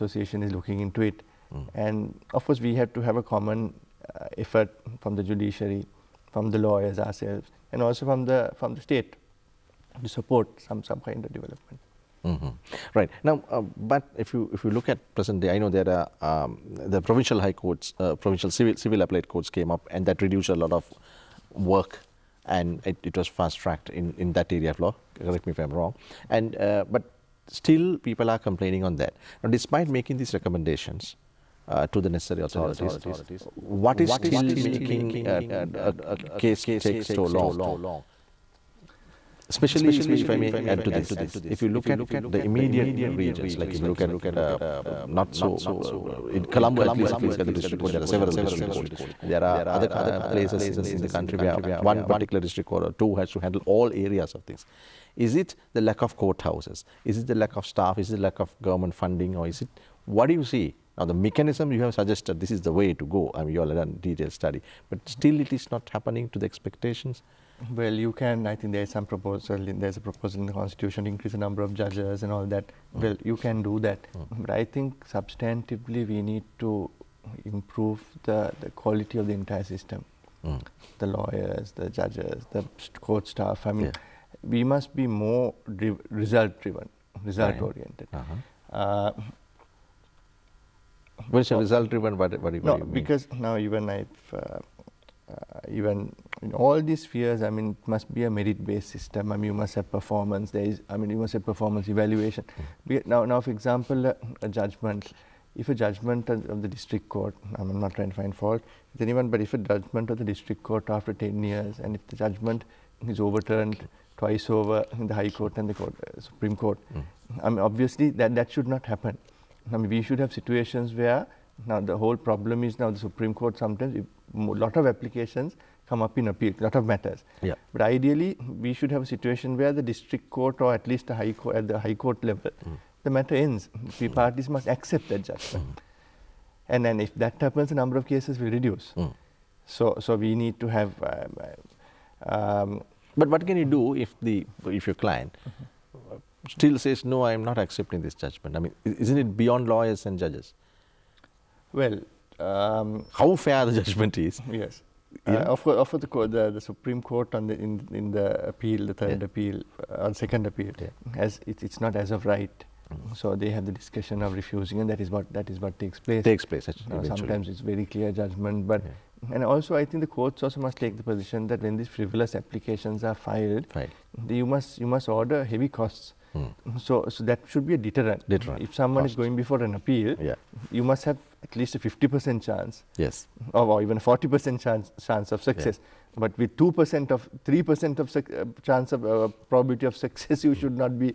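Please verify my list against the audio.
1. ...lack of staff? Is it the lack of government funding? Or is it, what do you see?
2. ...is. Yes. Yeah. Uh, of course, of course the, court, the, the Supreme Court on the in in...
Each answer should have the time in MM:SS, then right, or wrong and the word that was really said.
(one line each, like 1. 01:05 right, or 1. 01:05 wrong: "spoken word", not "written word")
1. 00:57 right
2. 02:34 right.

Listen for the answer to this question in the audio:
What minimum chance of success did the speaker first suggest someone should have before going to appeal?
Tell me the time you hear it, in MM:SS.
03:01.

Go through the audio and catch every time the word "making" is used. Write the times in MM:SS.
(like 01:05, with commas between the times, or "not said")
00:29, 00:34.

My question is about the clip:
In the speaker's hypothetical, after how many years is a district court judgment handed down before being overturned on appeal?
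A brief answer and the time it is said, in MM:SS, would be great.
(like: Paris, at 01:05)
10 years, at 01:51.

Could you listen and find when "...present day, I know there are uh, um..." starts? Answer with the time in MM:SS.
00:15.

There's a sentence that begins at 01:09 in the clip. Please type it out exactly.
In, there's a proposal in the constitution to increase the number of judges and all that.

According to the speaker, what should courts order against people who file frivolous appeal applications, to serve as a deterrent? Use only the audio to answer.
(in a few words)
Heavy costs.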